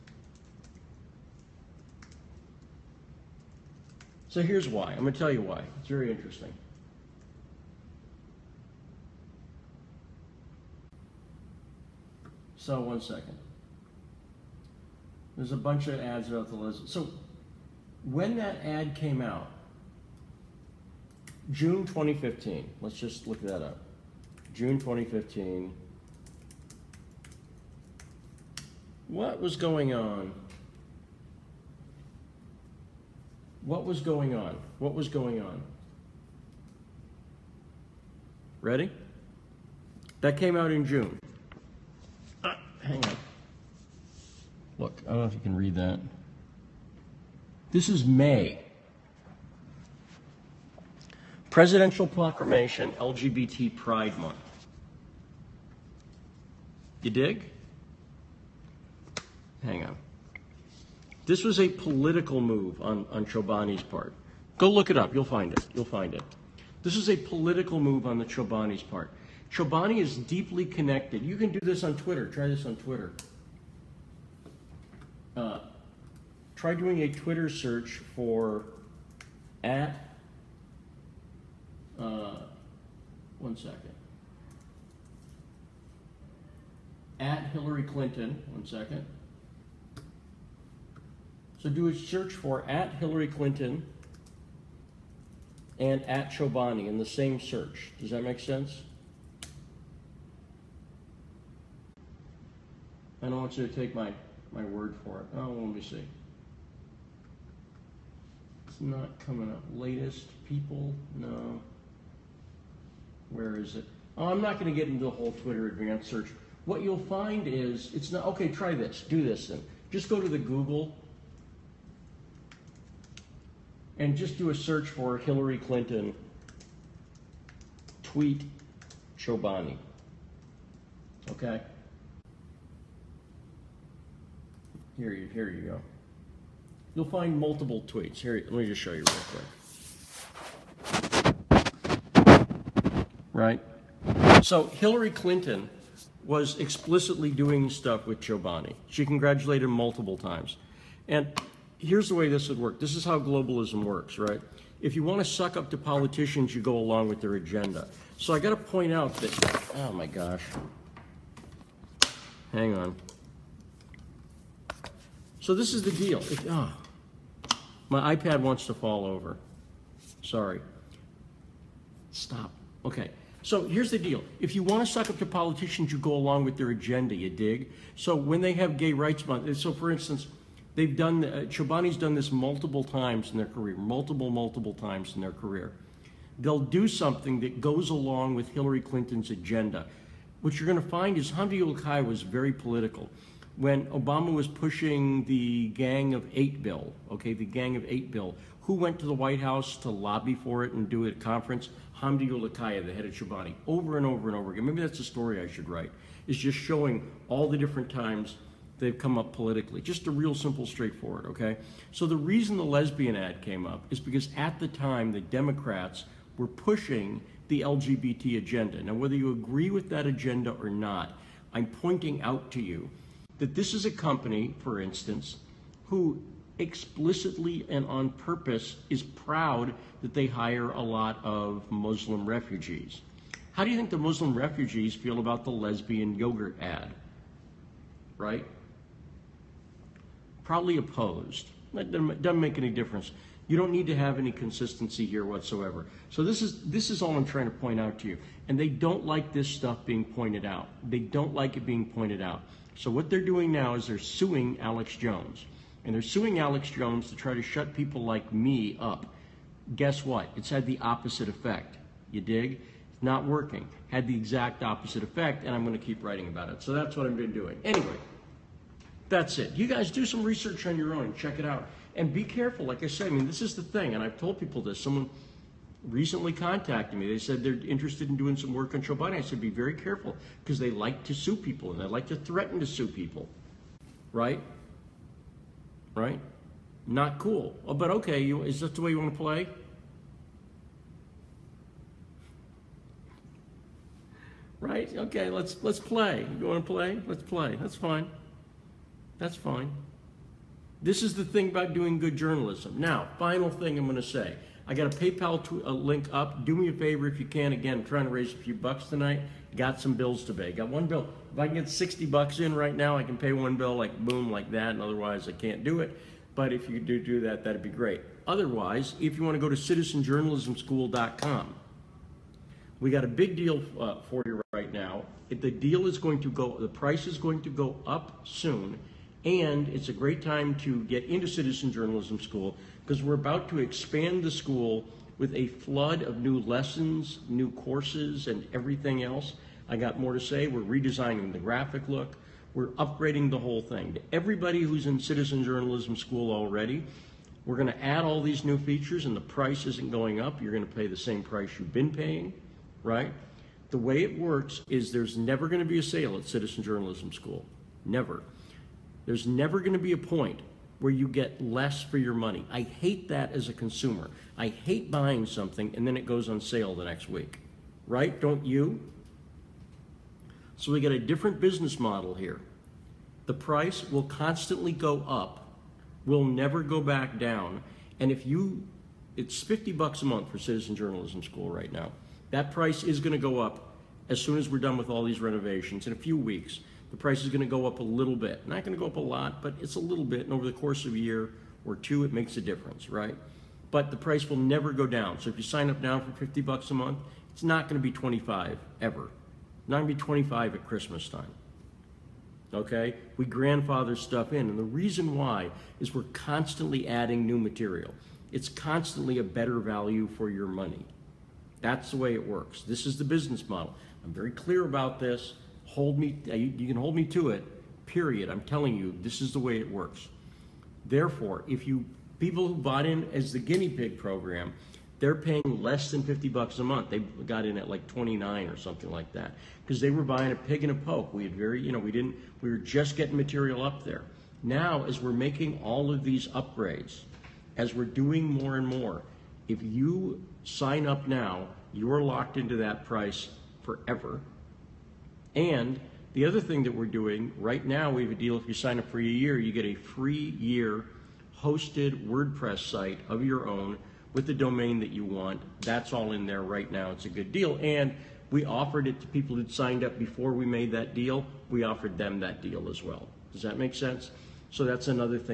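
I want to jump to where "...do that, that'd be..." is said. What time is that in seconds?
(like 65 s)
317 s.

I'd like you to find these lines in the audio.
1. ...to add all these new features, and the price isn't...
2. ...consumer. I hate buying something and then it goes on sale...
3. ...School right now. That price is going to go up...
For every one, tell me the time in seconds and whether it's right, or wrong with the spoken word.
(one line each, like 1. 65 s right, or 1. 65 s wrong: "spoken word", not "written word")
1. 347 s right
2. 363 s right
3. 381 s right.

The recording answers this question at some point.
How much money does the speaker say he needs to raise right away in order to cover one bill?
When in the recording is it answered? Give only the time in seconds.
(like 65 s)
311 s.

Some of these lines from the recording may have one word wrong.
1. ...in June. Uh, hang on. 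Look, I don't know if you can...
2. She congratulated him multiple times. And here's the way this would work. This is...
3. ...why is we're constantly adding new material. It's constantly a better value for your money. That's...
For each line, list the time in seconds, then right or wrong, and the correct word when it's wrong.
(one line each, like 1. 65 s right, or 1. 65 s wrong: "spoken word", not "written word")
1. 40 s right
2. 148 s right
3. 405 s right.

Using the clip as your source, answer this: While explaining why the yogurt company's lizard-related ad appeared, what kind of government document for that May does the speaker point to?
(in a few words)
Presidential Proclamation.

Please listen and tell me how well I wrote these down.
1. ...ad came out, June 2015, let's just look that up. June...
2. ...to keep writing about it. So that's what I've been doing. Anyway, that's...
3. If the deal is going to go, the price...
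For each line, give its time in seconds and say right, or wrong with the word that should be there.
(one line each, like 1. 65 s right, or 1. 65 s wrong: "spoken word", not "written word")
1. 18 s right
2. 265 s right
3. 325 s right.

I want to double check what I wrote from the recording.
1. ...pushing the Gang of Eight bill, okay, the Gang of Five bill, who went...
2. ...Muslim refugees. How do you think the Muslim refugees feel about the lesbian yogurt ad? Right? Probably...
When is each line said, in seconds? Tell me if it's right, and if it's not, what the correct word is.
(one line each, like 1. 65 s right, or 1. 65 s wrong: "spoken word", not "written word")
1. 194 s wrong: "Eight", not "Five"
2. 231 s right.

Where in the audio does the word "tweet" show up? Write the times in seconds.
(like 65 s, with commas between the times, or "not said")
128 s, 137 s.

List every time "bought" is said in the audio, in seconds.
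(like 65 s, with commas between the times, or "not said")
422 s.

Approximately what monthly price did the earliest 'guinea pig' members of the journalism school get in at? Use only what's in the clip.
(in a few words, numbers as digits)
29.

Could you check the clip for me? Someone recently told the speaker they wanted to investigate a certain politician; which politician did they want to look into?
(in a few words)
Joe Biden.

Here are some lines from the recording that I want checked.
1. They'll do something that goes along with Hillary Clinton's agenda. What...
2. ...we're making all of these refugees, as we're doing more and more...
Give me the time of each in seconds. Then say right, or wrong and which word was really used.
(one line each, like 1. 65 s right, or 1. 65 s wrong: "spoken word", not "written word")
1. 186 s right
2. 435 s wrong: "upgrades", not "refugees".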